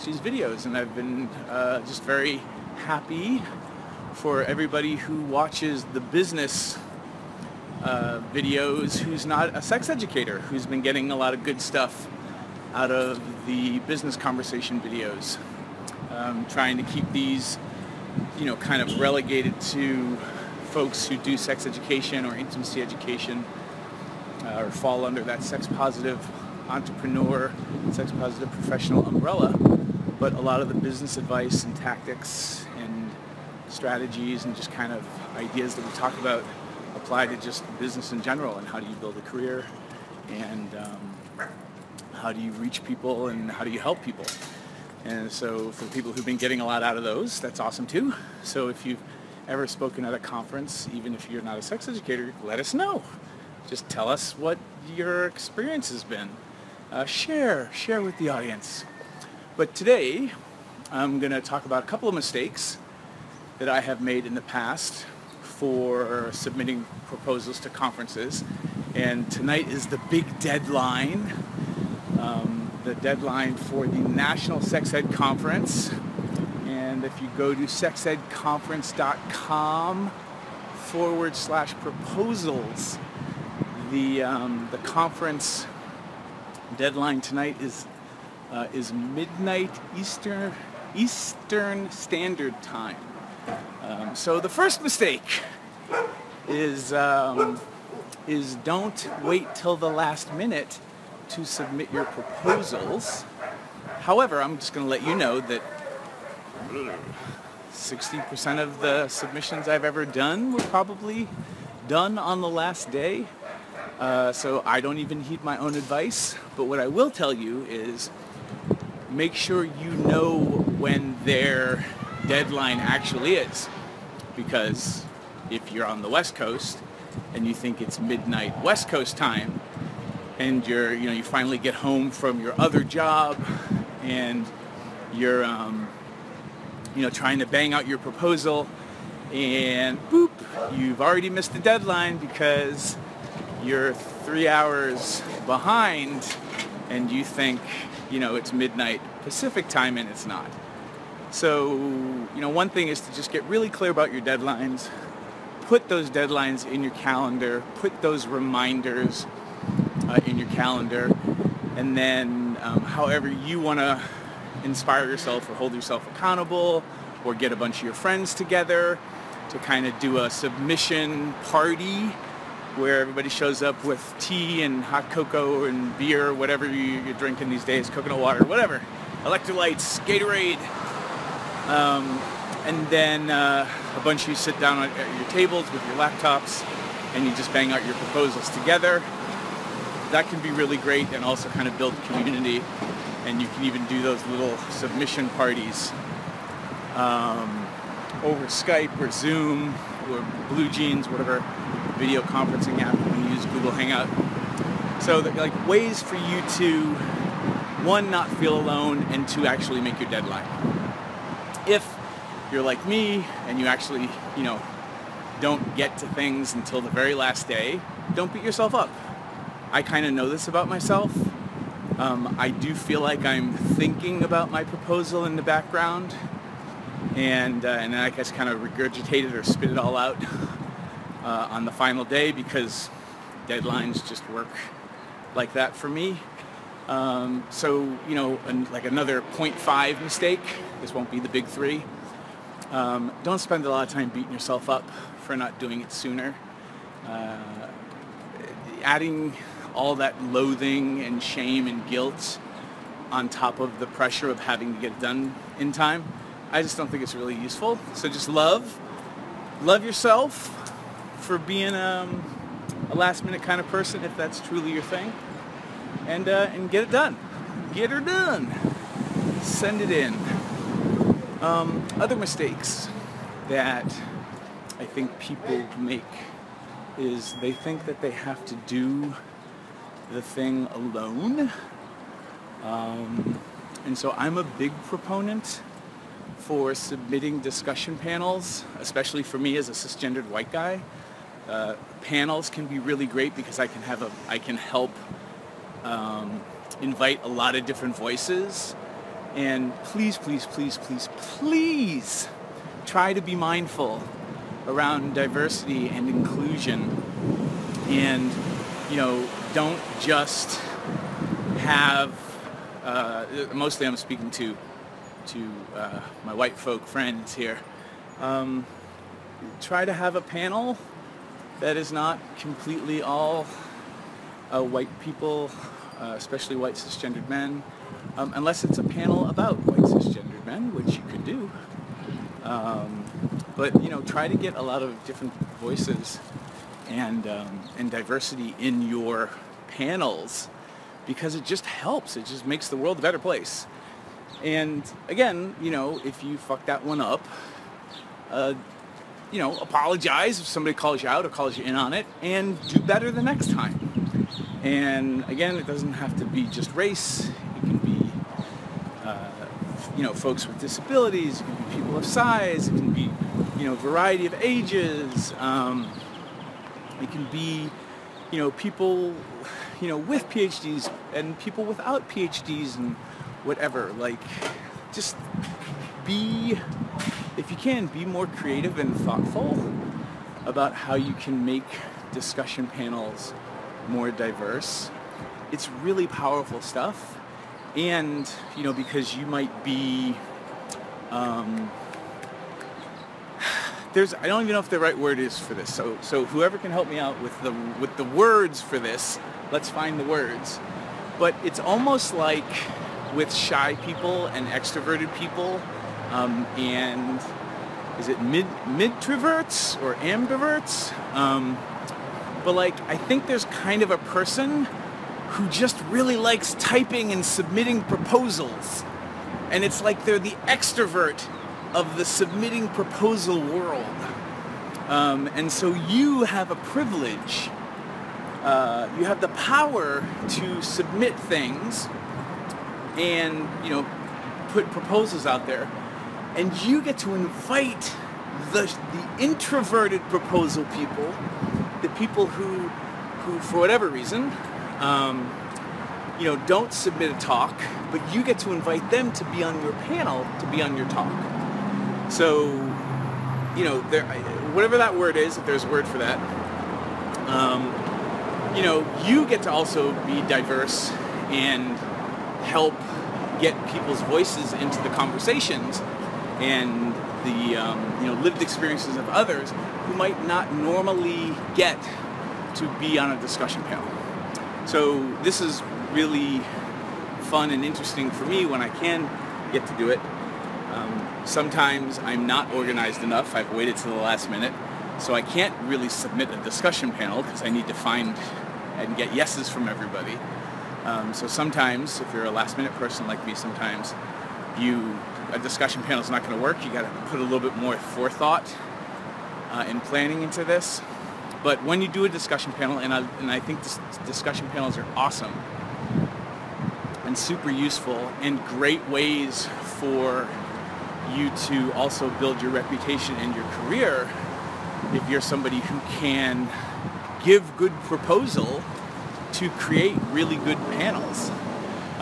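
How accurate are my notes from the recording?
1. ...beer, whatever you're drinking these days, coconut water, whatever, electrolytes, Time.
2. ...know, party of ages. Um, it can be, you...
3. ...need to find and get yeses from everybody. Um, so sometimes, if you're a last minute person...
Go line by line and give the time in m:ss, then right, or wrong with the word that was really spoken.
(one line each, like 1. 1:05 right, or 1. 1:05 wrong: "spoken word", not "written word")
1. 2:55 wrong: "Gatorade", not "Time"
2. 6:03 wrong: "variety", not "party"
3. 8:07 right.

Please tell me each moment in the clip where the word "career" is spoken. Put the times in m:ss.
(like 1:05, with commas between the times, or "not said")
0:39, 8:33.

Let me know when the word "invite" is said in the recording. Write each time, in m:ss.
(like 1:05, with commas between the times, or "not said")
4:56, 7:17, 7:28.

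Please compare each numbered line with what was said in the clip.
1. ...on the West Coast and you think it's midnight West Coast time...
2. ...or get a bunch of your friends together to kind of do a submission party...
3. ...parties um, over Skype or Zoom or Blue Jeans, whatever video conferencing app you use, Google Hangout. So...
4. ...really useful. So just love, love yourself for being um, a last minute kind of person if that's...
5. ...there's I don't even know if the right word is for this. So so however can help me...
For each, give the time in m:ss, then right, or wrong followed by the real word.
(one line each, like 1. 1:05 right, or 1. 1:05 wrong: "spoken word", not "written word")
1. 2:05 right
2. 2:47 right
3. 3:15 right
4. 4:17 right
5. 6:33 wrong: "whoever", not "however".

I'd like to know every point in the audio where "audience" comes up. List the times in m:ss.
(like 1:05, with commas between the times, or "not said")
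0:58.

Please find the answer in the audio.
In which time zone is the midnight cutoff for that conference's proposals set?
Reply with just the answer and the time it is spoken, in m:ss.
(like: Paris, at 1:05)
Eastern Standard Time, at 1:30.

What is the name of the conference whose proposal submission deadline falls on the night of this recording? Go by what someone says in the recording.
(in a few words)
National Sex Ed Conference.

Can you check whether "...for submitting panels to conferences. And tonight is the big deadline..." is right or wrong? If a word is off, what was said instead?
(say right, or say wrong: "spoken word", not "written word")
wrong: "proposals", not "panels".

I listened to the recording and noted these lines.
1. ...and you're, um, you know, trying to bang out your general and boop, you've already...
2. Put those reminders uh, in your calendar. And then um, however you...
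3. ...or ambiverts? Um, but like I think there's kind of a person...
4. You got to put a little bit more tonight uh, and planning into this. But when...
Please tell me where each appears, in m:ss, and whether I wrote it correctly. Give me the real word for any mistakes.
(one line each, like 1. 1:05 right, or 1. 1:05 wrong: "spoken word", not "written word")
1. 2:14 wrong: "proposal", not "general"
2. 2:37 right
3. 6:49 right
4. 8:16 wrong: "forethought", not "tonight".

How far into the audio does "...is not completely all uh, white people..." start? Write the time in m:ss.
5:21.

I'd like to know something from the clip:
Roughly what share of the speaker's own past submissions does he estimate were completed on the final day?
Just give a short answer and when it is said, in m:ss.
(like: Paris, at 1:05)
60%, at 1:47.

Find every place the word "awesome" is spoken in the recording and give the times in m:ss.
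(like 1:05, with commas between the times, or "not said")
0:47, 8:24.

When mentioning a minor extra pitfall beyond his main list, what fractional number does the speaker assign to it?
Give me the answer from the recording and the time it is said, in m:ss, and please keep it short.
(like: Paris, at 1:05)
0.5, at 3:59.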